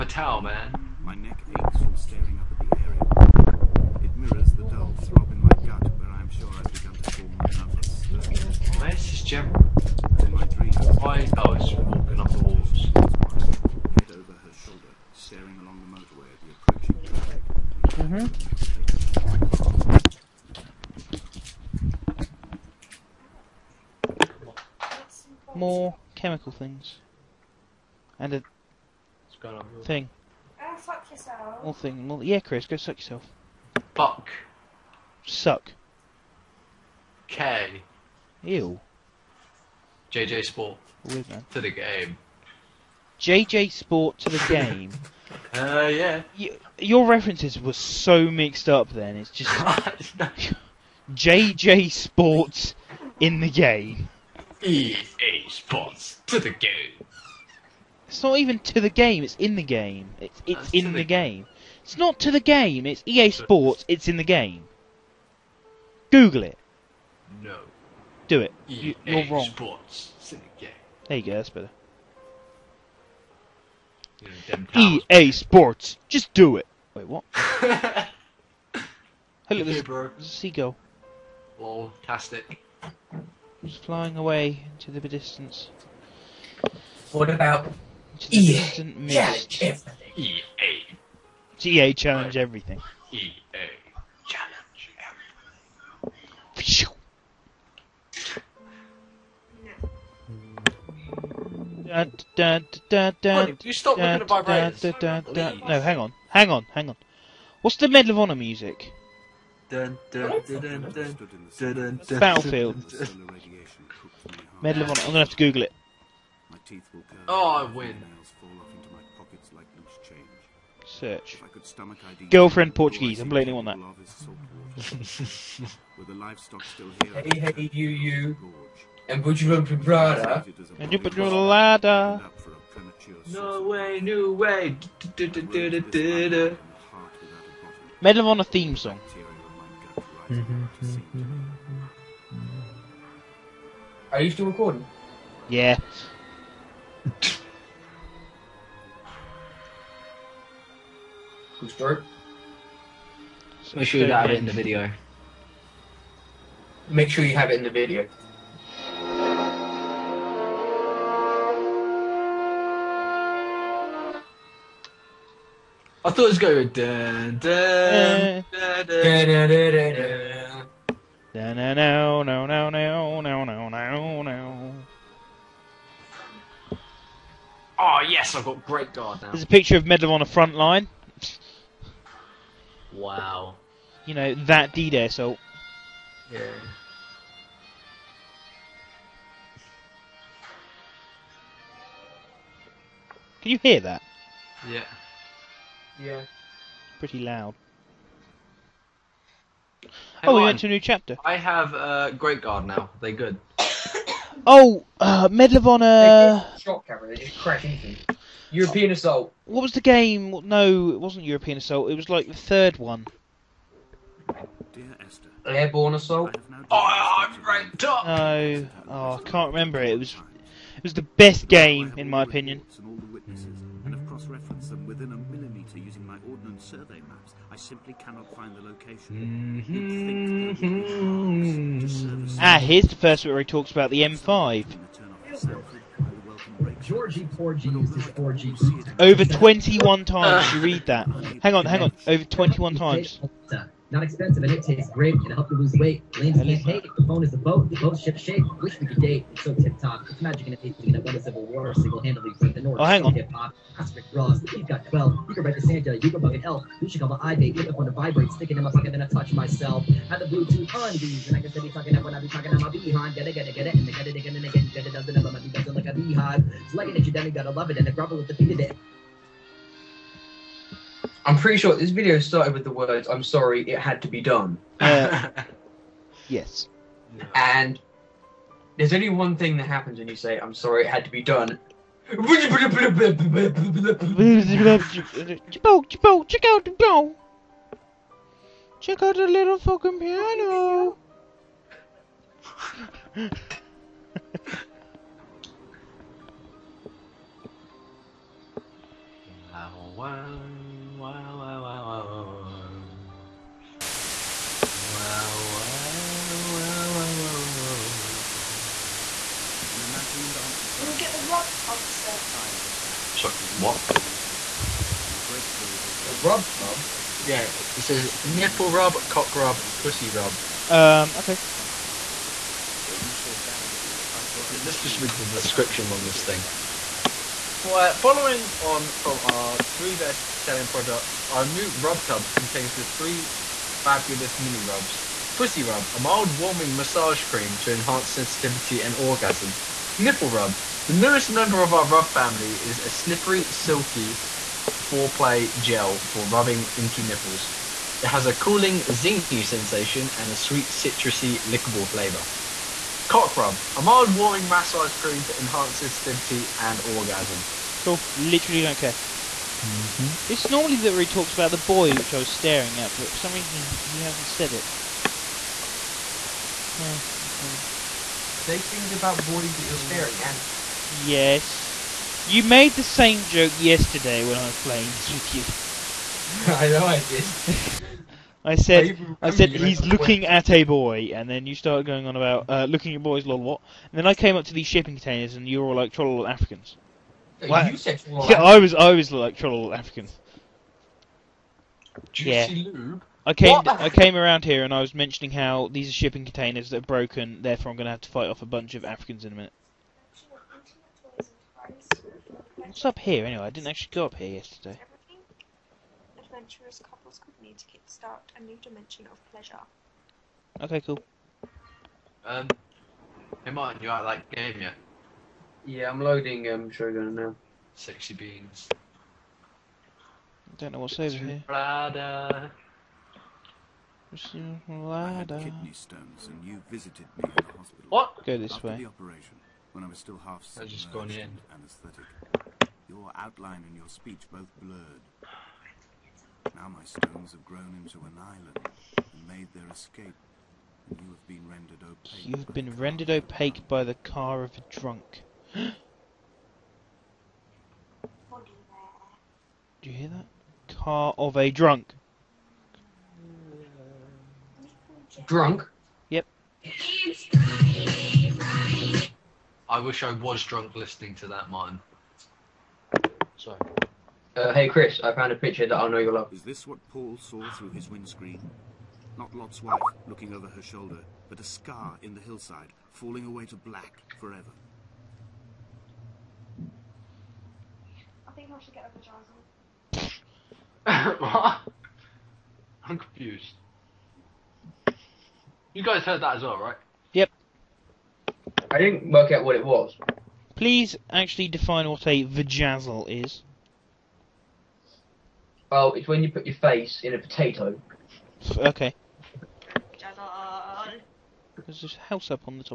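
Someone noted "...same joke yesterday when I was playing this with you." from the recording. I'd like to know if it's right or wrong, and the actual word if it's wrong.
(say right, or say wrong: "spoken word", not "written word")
right.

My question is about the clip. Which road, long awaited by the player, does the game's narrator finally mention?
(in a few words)
M5.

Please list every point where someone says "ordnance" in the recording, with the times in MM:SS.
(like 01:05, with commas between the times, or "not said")
03:46.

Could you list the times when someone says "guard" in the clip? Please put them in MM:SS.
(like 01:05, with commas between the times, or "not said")
02:58, 03:22.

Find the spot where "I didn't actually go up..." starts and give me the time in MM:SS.
06:43.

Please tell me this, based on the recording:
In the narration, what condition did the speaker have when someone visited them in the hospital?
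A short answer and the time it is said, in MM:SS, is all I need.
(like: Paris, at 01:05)
kidney stones, at 07:05.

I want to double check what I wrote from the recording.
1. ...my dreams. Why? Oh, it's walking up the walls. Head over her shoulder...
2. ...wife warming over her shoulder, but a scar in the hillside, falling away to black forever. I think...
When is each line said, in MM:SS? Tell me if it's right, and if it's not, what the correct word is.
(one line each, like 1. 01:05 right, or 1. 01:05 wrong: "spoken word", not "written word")
1. 00:10 right
2. 07:49 wrong: "looking", not "warming".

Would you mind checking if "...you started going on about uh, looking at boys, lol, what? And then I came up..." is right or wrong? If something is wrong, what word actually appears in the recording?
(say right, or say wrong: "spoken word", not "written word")
right.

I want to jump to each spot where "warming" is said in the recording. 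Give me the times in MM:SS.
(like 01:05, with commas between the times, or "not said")
05:36, 05:54.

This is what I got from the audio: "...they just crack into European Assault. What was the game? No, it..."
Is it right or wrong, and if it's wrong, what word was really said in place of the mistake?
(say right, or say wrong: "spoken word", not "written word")
right.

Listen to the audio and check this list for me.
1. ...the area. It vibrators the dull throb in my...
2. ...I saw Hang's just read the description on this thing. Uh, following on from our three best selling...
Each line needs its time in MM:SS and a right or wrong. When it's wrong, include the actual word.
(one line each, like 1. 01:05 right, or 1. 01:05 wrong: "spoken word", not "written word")
1. 00:02 wrong: "mirrors", not "vibrators"
2. 05:24 wrong: "Let", not "Hang".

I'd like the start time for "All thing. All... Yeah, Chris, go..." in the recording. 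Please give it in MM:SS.
00:31.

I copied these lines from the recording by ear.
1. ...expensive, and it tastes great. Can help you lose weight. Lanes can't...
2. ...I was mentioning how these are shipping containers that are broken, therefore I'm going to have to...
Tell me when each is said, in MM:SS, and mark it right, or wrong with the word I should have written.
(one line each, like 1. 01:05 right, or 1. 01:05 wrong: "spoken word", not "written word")
1. 04:04 right
2. 06:34 right.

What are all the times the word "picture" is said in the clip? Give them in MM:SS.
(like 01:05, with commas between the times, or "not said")
02:59, 07:45.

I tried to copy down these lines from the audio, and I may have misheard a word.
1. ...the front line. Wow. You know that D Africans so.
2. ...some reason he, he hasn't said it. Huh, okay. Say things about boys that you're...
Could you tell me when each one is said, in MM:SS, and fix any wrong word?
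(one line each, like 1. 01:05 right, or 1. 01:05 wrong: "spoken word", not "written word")
1. 03:00 wrong: "Day", not "Africans"
2. 06:03 right.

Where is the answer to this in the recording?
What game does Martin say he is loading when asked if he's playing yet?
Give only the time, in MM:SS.
06:56.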